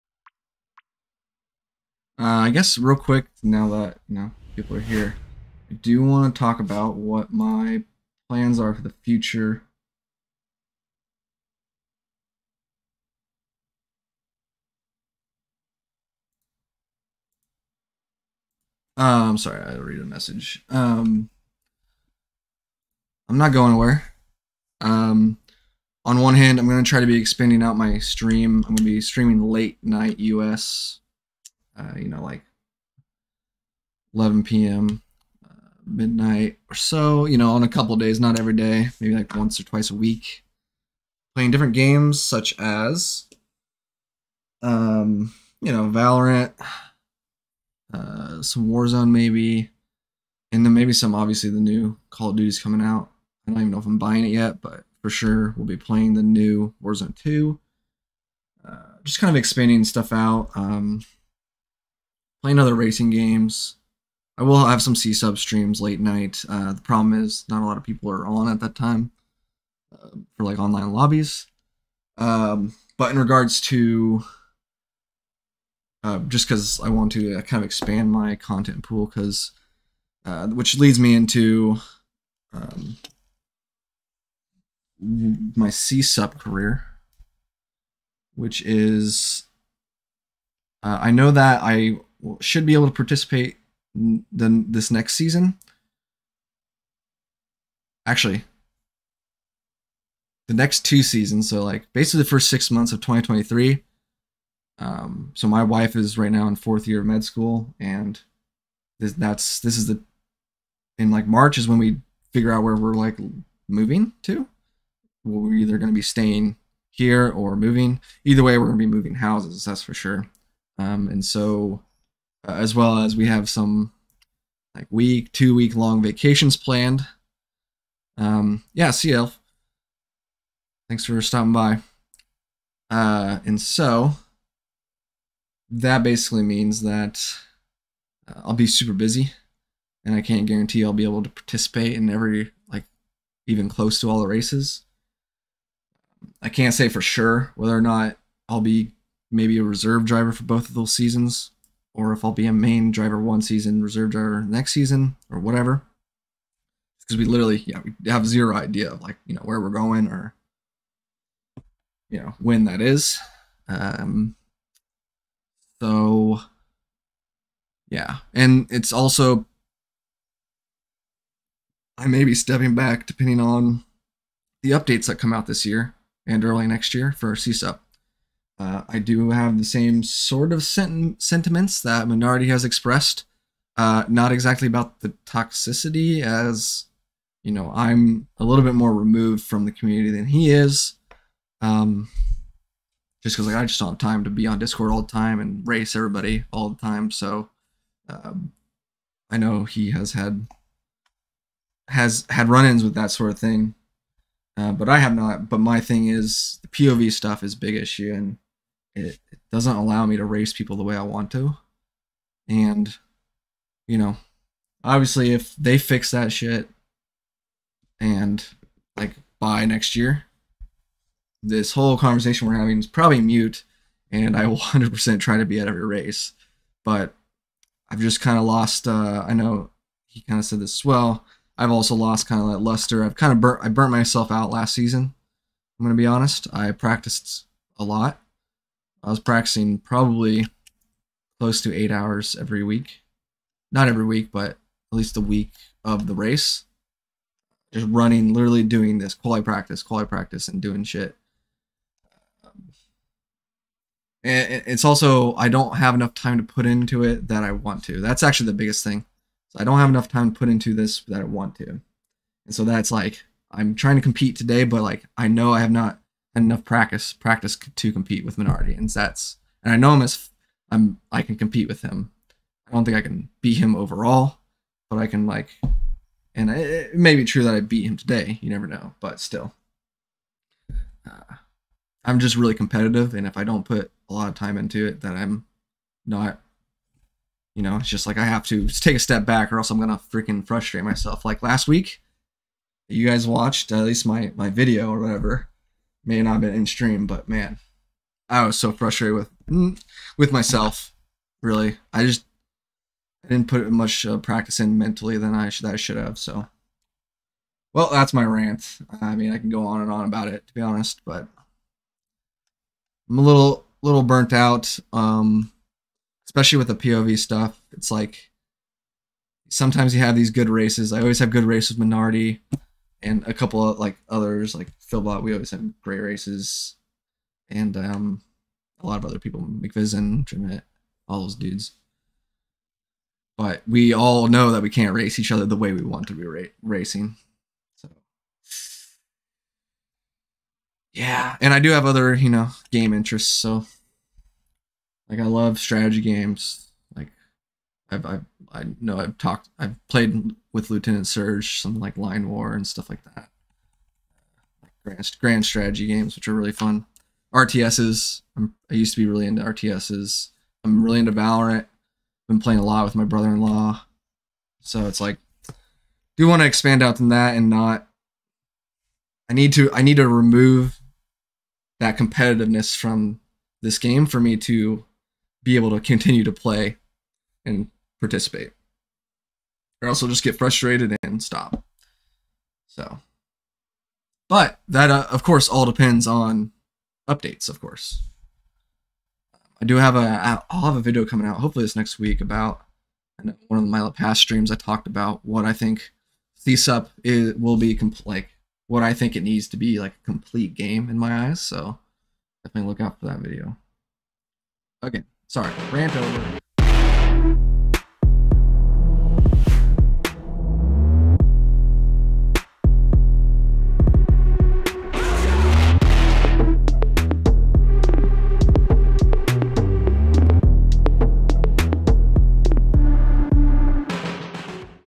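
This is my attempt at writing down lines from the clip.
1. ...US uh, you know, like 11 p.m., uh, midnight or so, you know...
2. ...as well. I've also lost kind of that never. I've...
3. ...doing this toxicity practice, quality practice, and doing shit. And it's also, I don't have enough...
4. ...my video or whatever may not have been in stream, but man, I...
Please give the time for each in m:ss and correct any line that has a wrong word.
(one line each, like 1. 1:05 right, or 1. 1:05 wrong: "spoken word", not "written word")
1. 0:30 right
2. 3:50 wrong: "luster", not "never"
3. 4:08 wrong: "quality", not "toxicity"
4. 4:54 right.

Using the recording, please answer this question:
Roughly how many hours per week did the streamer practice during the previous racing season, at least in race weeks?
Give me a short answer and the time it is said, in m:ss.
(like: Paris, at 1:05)
8, at 4:01.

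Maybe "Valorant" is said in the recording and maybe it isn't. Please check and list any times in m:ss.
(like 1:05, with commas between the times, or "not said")
0:45, 6:01.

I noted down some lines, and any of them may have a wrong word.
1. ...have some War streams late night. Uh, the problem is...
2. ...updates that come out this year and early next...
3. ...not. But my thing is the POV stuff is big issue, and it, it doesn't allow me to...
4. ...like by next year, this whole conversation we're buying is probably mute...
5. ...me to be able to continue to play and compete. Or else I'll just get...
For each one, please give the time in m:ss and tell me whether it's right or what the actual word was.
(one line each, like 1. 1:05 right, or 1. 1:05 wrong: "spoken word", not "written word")
1. 1:04 wrong: "CSUP", not "War"
2. 2:54 right
3. 3:25 right
4. 3:38 wrong: "having", not "buying"
5. 6:14 wrong: "participate", not "compete".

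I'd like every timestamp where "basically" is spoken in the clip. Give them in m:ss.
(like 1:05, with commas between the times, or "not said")
1:41, 2:16.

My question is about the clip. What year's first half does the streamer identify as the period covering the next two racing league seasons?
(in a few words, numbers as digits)
2023.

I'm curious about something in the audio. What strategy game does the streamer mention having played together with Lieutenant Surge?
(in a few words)
Line War.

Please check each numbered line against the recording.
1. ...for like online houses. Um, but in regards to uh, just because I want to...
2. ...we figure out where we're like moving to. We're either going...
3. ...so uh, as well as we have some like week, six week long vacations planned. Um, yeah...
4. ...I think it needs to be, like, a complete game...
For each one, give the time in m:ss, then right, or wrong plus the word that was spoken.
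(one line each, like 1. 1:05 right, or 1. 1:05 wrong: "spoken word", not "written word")
1. 1:10 wrong: "lobbies", not "houses"
2. 1:51 right
3. 2:01 wrong: "two", not "six"
4. 6:38 right.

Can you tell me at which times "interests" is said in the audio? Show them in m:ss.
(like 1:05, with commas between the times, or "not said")
5:42.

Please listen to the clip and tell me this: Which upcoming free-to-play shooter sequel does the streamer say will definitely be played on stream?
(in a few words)
Warzone 2.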